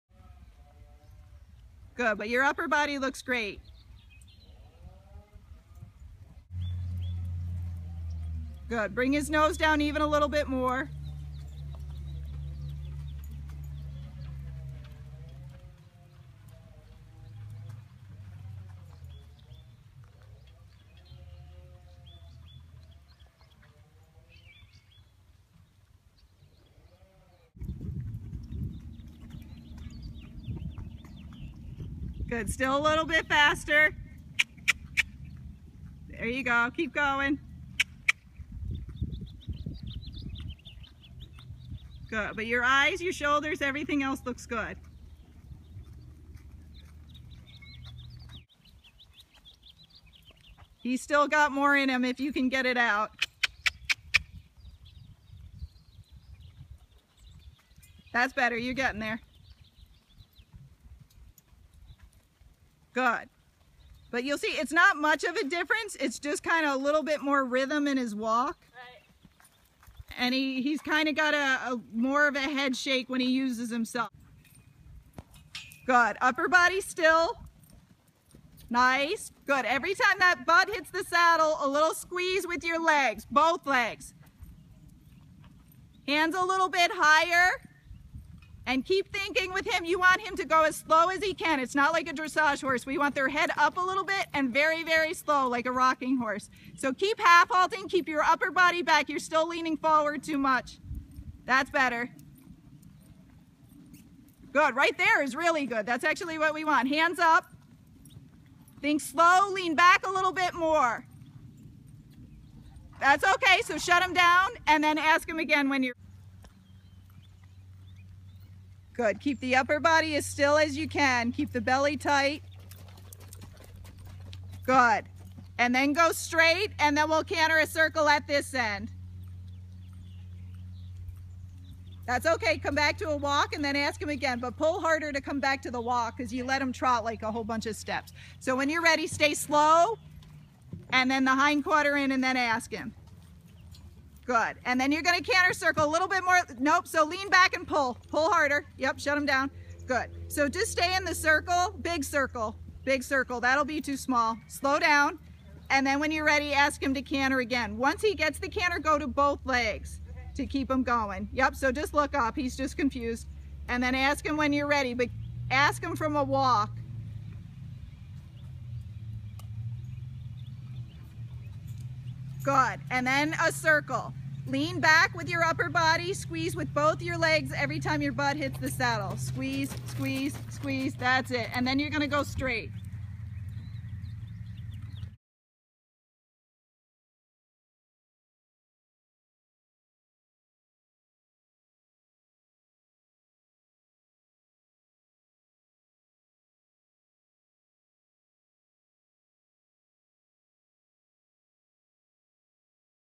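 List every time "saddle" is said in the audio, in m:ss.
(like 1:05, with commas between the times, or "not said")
1:21, 2:58.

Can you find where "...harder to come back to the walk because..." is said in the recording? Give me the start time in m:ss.
2:14.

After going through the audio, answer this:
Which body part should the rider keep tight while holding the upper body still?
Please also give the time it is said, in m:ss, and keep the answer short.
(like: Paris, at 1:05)
Belly, at 2:01.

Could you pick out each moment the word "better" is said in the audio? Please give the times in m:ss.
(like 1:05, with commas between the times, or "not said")
0:58, 1:41.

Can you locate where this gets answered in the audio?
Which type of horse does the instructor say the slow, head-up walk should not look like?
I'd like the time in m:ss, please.
1:32.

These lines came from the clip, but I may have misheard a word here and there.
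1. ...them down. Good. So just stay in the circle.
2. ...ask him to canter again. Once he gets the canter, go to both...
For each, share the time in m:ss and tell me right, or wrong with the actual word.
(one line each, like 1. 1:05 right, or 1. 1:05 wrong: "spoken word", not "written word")
1. 2:29 right
2. 2:36 right.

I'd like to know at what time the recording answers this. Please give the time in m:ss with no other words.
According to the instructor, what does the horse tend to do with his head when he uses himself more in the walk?
1:12.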